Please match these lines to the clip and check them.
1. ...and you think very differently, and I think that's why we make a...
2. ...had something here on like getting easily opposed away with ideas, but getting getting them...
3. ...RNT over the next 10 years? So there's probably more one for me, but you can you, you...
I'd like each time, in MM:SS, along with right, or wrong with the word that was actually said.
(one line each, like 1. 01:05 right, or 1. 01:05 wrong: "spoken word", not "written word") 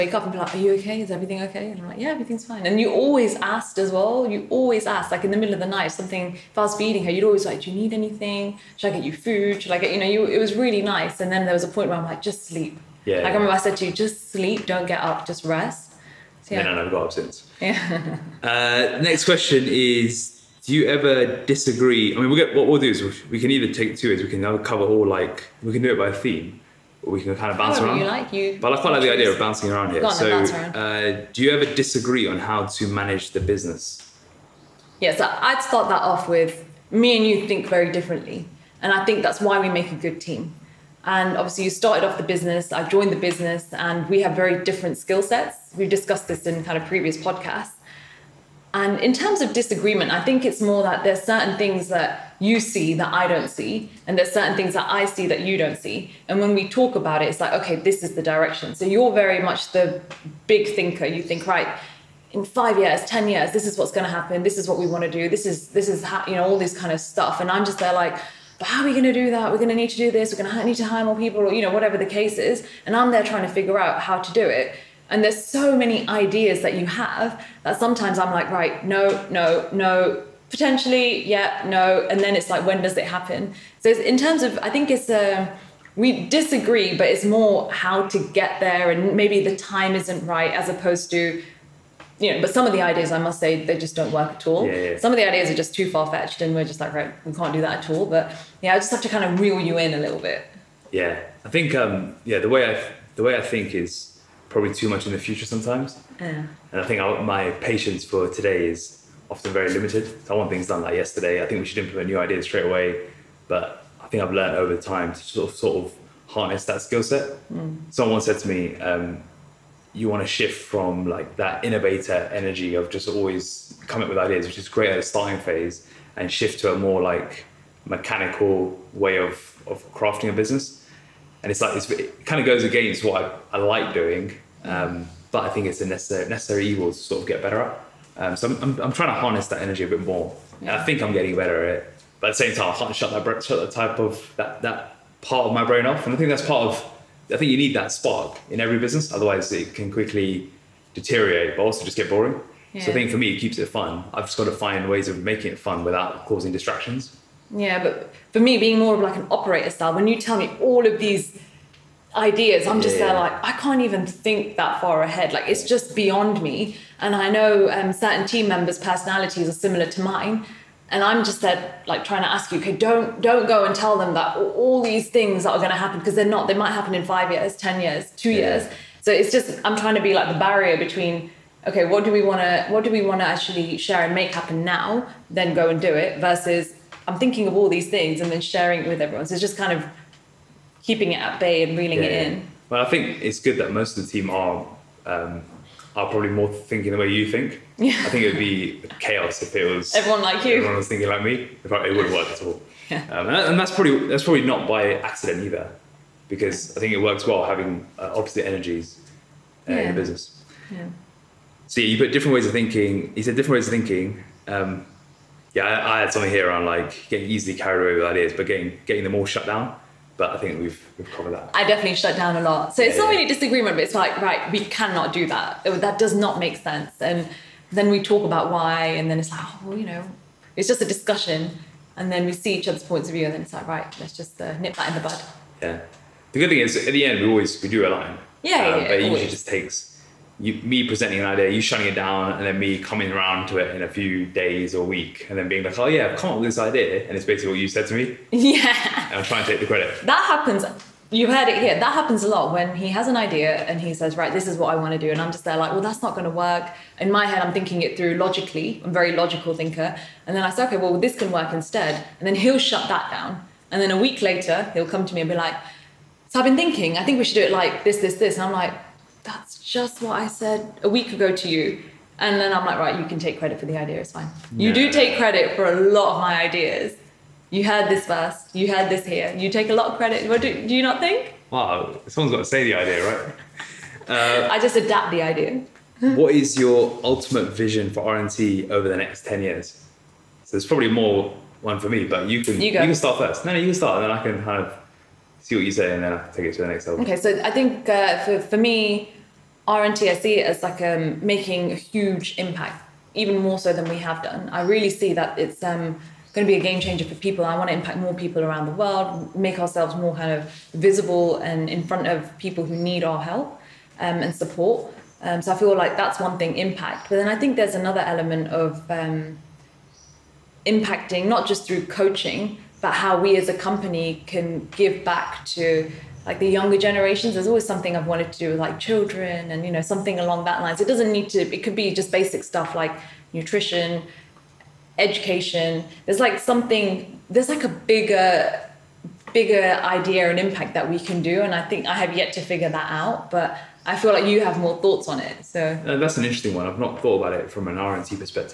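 1. 00:37 right
2. 03:36 wrong: "carried", not "opposed"
3. 04:48 right.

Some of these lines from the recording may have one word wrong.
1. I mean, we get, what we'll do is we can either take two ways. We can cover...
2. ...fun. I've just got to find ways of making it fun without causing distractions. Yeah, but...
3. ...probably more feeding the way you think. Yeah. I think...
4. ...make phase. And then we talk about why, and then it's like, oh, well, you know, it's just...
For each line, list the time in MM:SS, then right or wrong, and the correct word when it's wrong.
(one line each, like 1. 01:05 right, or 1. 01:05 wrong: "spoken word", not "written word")
1. 00:22 right
2. 02:33 right
3. 03:16 wrong: "thinking", not "feeding"
4. 03:46 wrong: "sense", not "phase".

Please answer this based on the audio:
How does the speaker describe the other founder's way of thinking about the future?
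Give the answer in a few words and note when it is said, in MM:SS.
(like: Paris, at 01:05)
big thinker, at 01:00.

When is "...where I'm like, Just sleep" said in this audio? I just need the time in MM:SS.
00:11.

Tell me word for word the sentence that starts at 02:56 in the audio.
They might happen in five years, ten years, two yeah.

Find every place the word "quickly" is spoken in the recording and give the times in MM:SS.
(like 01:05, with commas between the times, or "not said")
02:29.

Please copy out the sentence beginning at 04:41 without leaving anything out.
Wow, someone's got to say the idea, right?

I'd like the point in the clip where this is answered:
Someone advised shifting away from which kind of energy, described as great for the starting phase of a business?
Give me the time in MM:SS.
02:01.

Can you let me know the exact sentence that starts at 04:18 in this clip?
I'm a very logical thinker, and then I say, "Okay, well, this can work instead," and then he'll shut that down.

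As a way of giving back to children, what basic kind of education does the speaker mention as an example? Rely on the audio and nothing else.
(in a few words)
nutrition education.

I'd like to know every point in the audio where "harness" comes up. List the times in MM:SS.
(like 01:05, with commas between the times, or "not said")
01:56, 02:19.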